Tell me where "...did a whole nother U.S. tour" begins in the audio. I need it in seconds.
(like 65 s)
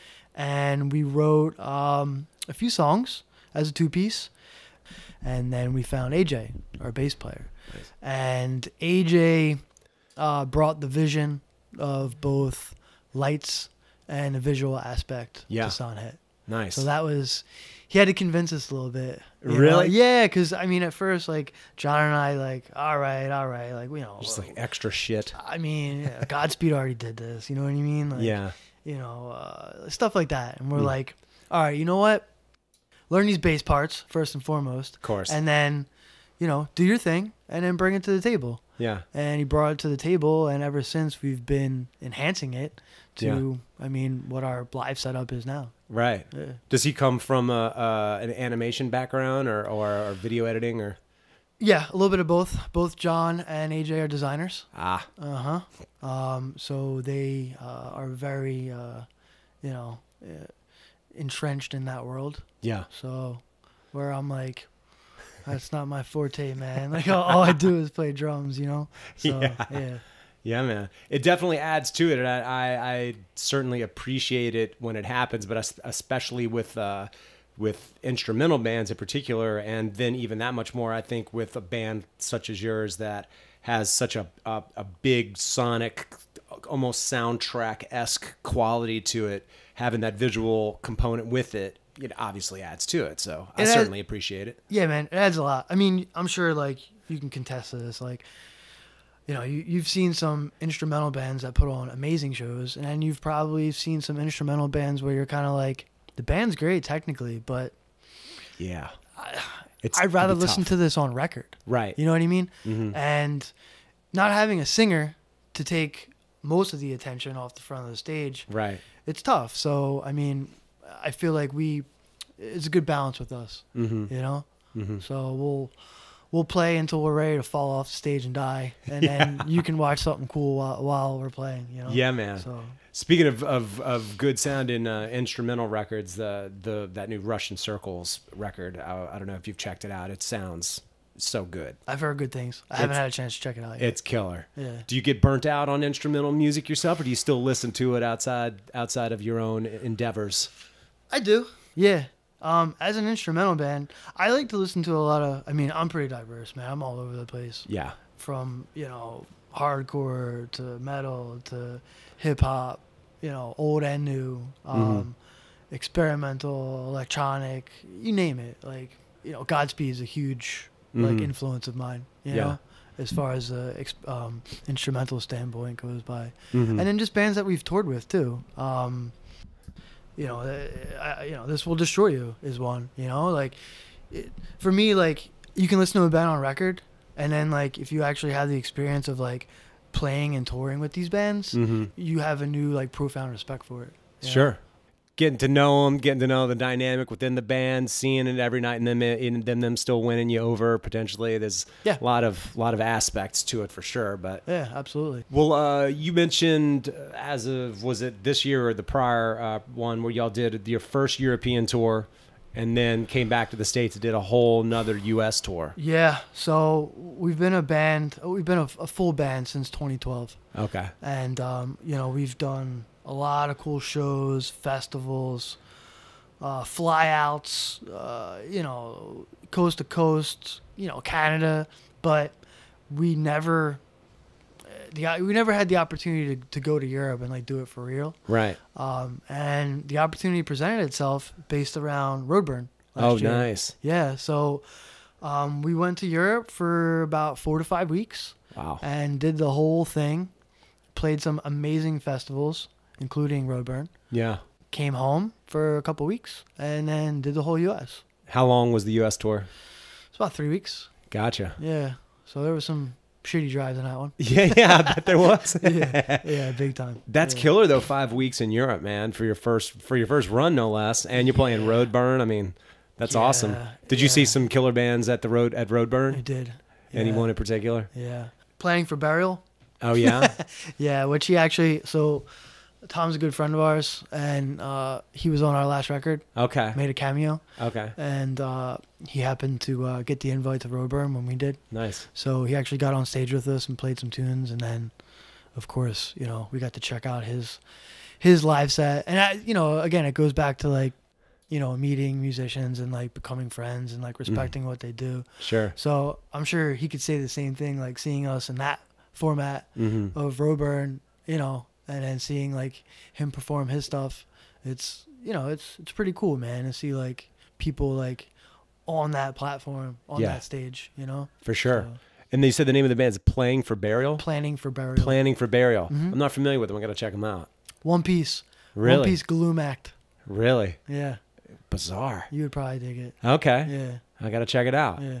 214 s.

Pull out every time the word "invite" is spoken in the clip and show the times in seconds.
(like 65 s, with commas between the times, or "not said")
290 s.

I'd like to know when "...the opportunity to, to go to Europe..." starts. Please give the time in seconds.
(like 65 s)
235 s.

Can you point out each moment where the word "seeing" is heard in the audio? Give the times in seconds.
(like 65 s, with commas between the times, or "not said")
197 s, 307 s, 312 s.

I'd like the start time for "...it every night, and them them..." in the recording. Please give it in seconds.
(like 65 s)
198 s.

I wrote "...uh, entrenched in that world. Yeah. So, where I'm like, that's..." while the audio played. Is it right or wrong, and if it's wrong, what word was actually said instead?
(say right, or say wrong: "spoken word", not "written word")
right.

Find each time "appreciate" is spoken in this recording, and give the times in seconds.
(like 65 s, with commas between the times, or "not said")
73 s, 93 s.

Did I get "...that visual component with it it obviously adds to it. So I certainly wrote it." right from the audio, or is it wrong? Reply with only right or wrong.
wrong.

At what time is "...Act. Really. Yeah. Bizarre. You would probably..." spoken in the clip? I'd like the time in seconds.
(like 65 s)
329 s.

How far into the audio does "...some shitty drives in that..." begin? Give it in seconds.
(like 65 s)
262 s.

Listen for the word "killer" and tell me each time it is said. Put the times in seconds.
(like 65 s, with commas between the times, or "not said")
144 s, 267 s, 274 s.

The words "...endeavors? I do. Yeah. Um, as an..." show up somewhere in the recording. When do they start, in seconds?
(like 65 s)
149 s.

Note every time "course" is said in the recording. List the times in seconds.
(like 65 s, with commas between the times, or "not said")
35 s, 295 s.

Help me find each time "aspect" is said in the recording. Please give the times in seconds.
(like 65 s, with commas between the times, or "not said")
14 s, 202 s.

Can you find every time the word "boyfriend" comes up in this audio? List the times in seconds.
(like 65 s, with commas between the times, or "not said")
not said.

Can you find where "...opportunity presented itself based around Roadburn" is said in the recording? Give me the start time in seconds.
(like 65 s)
239 s.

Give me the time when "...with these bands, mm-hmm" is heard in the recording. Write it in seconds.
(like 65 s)
190 s.